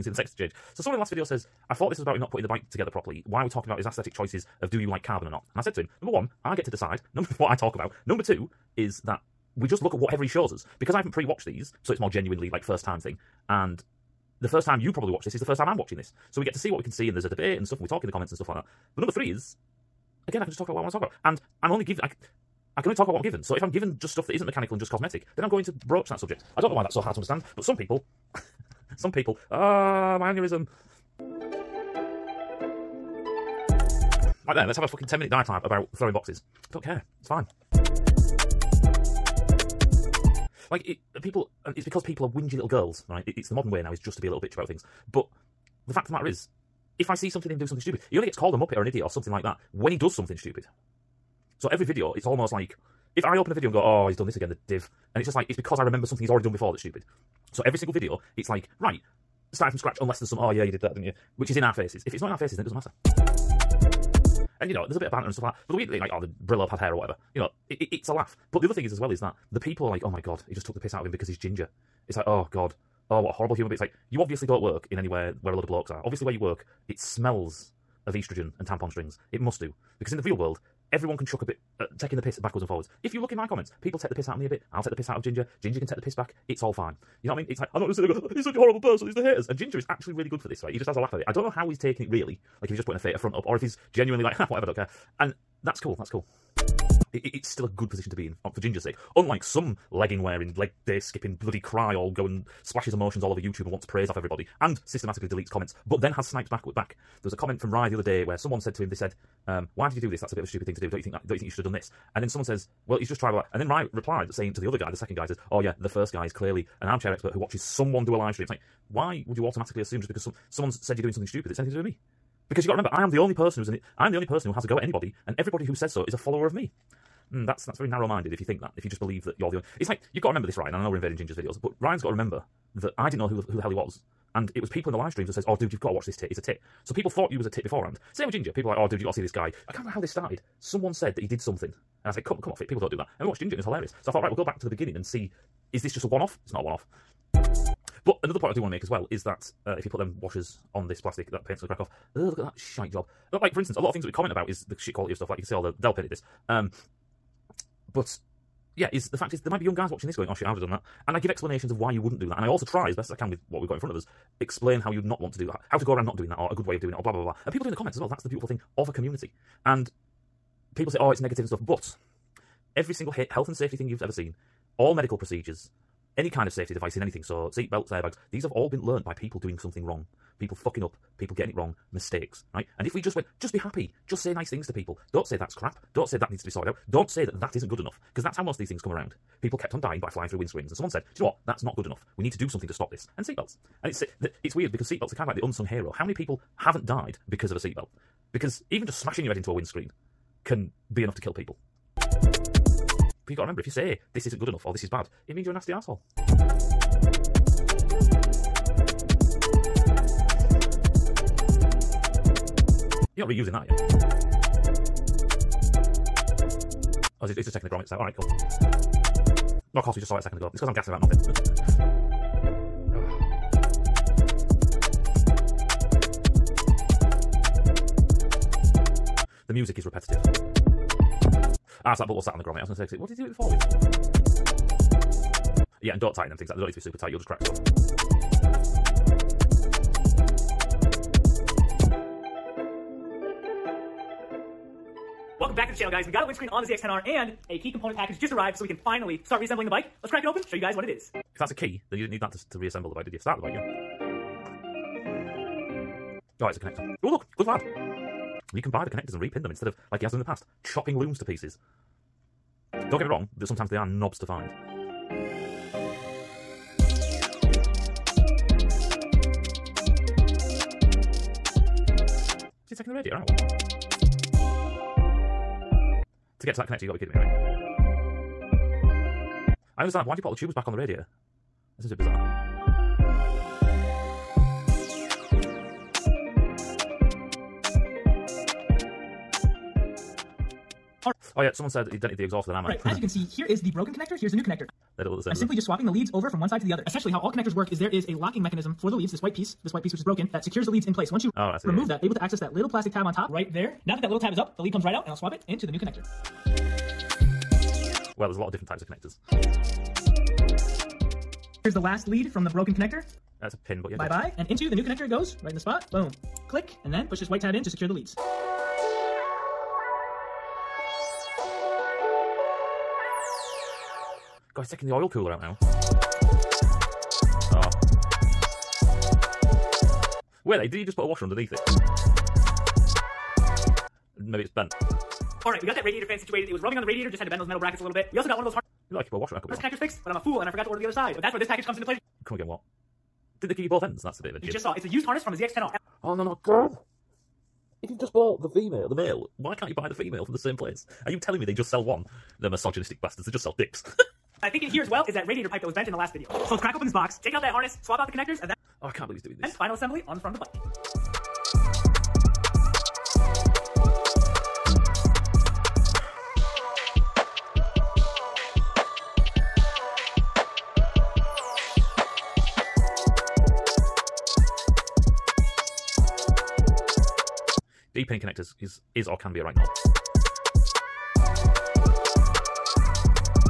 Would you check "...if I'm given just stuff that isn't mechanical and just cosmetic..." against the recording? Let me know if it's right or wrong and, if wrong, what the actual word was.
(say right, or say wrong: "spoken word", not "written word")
right.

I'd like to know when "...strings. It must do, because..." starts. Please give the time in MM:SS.
01:18.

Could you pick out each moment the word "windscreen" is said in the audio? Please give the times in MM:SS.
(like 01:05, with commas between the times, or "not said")
03:10, 03:19, 04:06.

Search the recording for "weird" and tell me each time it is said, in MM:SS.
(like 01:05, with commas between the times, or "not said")
01:05, 03:14.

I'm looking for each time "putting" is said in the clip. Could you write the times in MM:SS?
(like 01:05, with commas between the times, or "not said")
00:02, 01:32.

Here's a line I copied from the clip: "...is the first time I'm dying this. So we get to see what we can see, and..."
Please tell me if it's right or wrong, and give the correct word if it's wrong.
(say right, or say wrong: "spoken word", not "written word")
wrong: "watching", not "dying".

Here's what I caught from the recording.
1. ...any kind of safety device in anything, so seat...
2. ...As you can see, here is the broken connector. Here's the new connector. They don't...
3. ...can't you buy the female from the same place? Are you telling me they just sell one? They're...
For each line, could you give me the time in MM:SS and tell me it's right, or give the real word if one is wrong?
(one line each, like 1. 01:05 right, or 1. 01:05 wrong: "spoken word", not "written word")
1. 02:56 right
2. 04:52 right
3. 05:49 right.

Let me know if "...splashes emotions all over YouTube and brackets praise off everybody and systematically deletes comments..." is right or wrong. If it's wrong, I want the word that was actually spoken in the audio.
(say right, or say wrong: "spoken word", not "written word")
wrong: "wants", not "brackets".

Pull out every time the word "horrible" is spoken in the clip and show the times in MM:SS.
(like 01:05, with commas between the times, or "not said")
01:13, 01:28.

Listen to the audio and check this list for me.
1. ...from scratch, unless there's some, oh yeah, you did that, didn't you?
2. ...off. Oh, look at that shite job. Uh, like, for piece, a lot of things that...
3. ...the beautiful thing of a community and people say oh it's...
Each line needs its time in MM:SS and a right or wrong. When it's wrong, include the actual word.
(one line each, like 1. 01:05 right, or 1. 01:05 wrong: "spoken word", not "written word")
1. 00:59 right
2. 02:31 wrong: "instance", not "piece"
3. 02:48 right.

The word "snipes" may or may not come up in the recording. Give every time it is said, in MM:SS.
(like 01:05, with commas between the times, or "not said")
01:46.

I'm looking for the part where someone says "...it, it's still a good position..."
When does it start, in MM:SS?
01:37.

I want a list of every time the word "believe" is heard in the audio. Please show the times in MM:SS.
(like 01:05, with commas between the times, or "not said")
02:09, 05:59.